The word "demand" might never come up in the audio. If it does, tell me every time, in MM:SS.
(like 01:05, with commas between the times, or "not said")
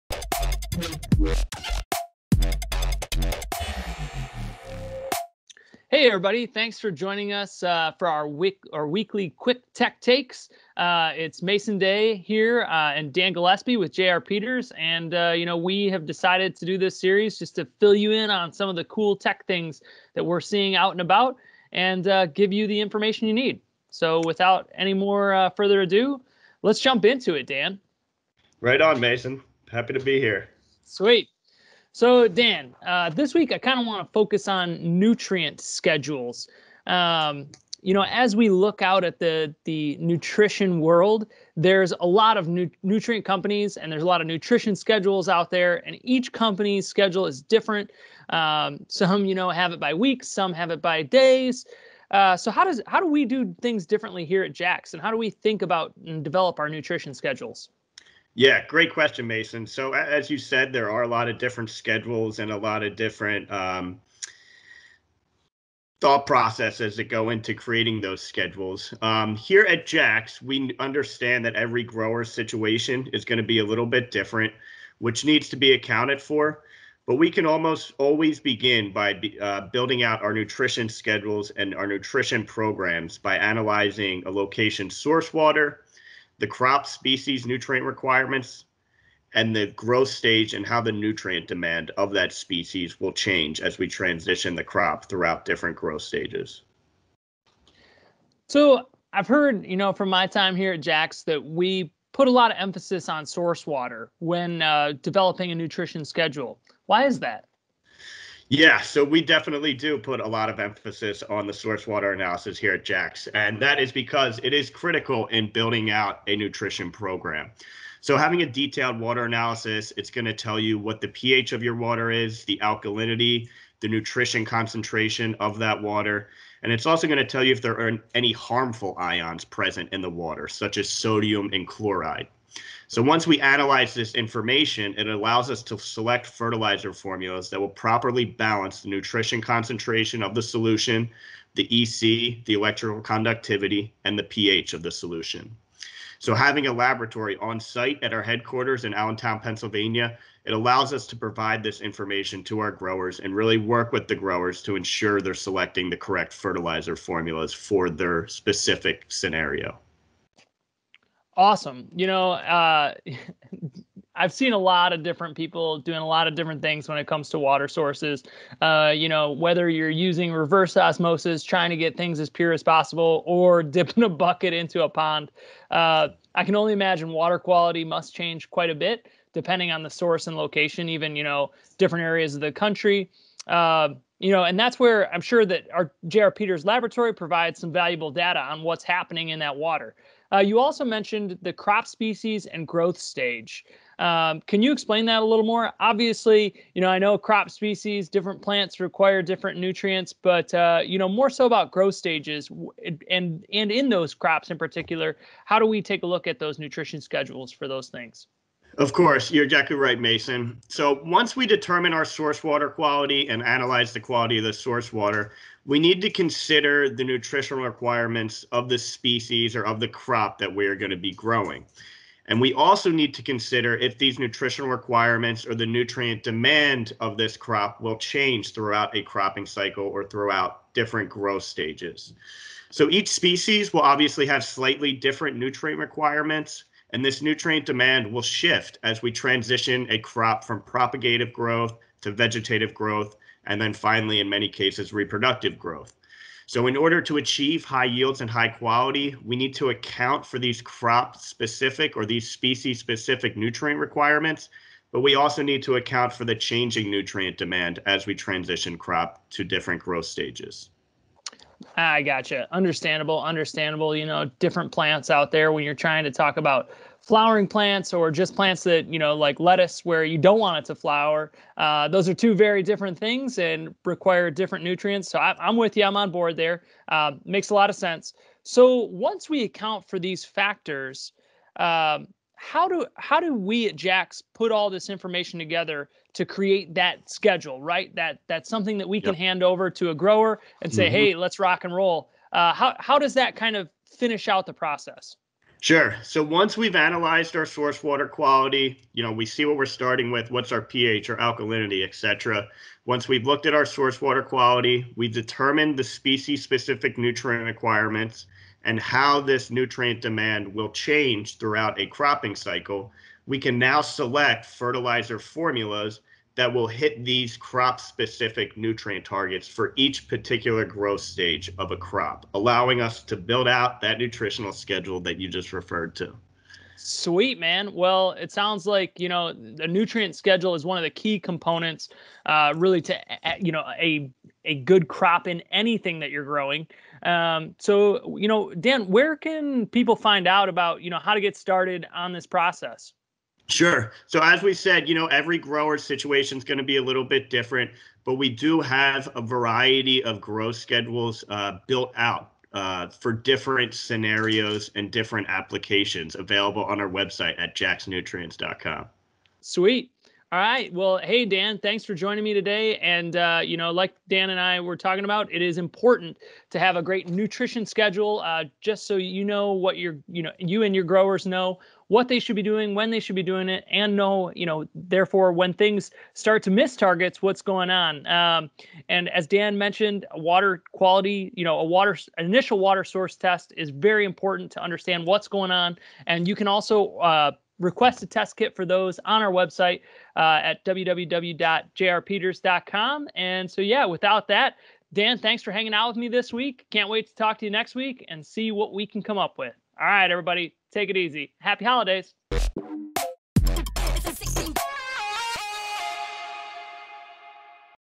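01:31, 03:46, 03:57, 04:17, 05:10.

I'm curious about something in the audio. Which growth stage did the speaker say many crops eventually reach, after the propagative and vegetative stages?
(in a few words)
reproductive growth.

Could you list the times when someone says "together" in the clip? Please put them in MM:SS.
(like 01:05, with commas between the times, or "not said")
04:45.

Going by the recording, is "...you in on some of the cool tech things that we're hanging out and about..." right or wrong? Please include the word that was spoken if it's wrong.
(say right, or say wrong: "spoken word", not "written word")
wrong: "seeing", not "hanging".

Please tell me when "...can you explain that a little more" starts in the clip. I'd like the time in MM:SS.
03:14.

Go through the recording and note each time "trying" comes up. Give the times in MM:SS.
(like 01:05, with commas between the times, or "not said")
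02:51, 04:25.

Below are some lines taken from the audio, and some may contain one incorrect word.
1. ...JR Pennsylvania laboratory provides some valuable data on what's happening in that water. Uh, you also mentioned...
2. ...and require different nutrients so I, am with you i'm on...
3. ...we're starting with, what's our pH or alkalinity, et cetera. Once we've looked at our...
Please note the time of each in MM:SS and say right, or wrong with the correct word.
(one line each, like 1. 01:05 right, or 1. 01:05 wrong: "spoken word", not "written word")
1. 03:06 wrong: "Peters", not "Pennsylvania"
2. 04:33 right
3. 04:59 right.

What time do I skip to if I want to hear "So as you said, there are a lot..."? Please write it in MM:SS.
00:59.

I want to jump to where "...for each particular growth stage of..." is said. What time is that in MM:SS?
05:19.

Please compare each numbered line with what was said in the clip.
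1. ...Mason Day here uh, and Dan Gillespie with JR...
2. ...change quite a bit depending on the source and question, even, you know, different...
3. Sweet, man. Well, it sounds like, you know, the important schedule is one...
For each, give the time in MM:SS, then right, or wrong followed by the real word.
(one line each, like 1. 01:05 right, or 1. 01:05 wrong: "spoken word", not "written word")
1. 00:11 right
2. 02:58 wrong: "location", not "question"
3. 05:26 wrong: "nutrient", not "important".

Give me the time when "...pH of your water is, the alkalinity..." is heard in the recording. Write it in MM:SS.
02:01.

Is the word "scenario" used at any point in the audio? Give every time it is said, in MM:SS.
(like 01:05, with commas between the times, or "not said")
02:39, 05:53.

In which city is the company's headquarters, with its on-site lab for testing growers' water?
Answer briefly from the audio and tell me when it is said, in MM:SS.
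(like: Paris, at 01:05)
Allentown, Pennsylvania, at 02:28.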